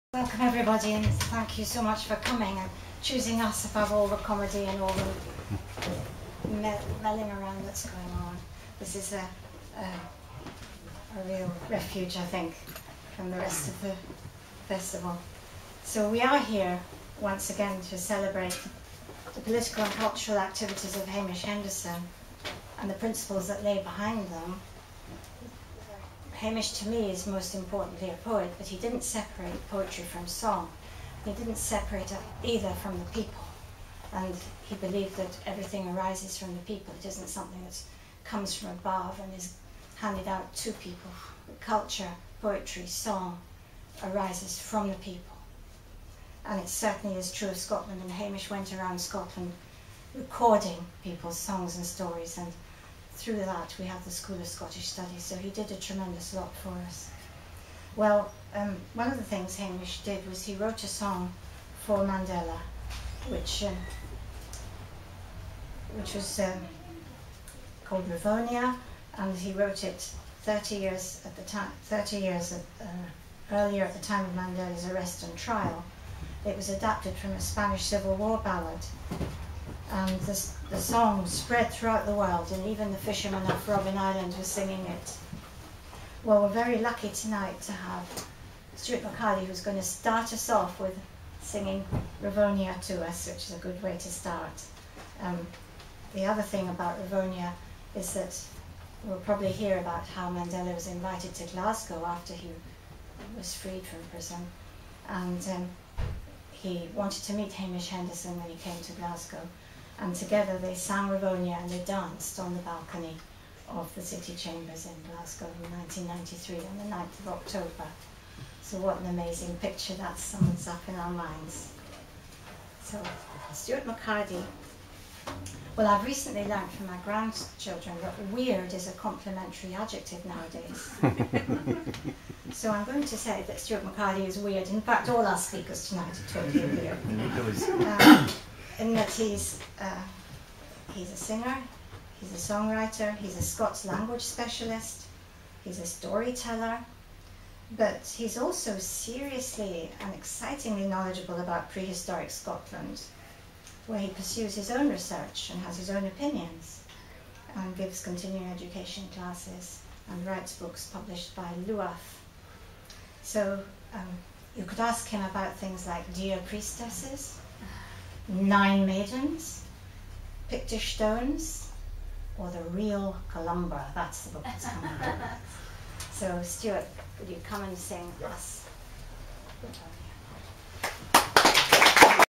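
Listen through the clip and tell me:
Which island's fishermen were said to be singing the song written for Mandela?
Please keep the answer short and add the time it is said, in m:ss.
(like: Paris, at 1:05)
Robben Island, at 1:23.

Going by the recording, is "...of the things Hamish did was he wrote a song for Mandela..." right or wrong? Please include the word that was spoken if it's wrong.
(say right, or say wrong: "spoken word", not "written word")
right.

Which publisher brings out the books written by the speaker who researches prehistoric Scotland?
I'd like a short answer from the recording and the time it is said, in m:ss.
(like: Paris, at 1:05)
Luath, at 2:41.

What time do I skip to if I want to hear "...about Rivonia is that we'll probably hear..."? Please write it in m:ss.
1:36.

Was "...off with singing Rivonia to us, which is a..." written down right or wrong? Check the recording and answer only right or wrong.
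right.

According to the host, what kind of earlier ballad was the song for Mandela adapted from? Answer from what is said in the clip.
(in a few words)
Spanish Civil War ballad.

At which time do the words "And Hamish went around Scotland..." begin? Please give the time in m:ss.
0:48.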